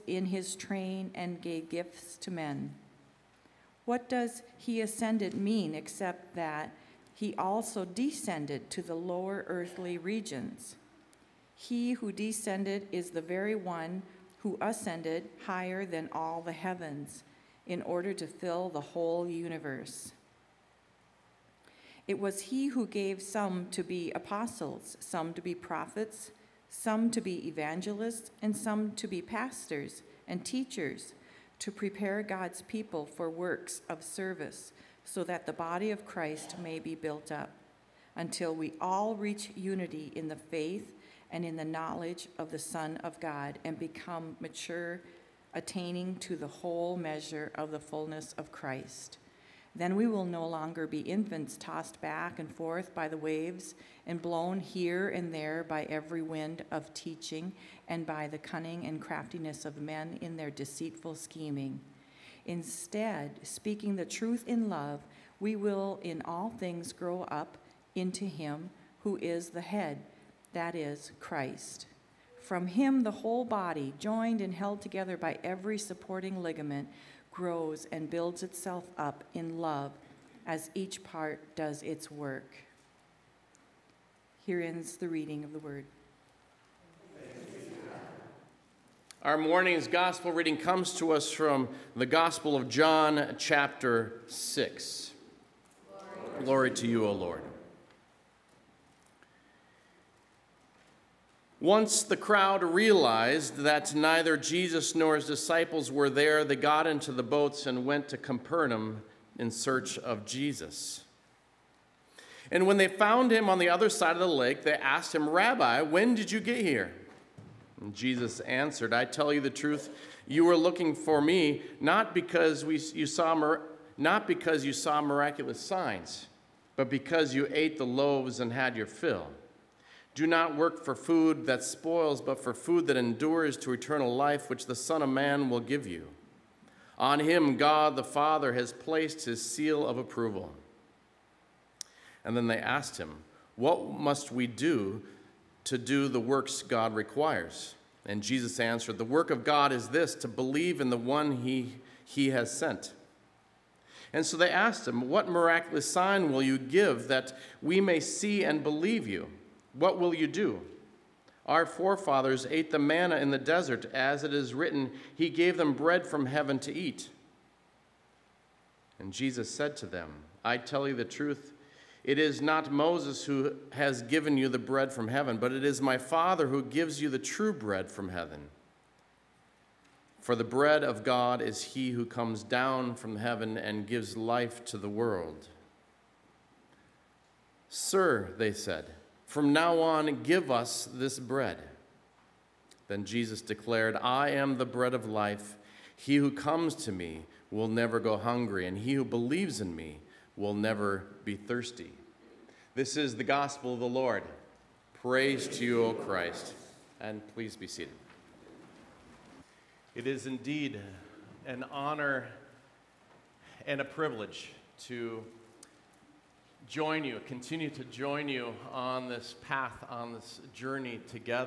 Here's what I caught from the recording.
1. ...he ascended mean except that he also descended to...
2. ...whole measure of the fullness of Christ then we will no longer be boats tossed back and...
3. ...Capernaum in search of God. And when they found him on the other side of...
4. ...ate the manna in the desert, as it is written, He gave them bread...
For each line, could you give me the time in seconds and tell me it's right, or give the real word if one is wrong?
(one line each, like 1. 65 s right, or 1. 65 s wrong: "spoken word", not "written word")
1. 4 s right
2. 46 s wrong: "infants", not "boats"
3. 108 s wrong: "Jesus", not "God"
4. 162 s right.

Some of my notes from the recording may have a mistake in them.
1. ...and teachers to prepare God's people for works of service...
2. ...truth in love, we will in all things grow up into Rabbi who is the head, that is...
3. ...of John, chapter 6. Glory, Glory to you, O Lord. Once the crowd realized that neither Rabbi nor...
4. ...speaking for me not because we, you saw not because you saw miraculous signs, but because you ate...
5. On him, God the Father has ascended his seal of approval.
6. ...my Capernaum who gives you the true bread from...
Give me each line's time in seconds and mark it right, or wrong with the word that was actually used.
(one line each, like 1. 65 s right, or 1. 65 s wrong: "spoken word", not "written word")
1. 30 s right
2. 64 s wrong: "Him", not "Rabbi"
3. 92 s wrong: "Jesus", not "Rabbi"
4. 120 s wrong: "looking", not "speaking"
5. 136 s wrong: "placed", not "ascended"
6. 175 s wrong: "Father", not "Capernaum".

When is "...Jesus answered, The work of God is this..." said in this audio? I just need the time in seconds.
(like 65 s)
148 s.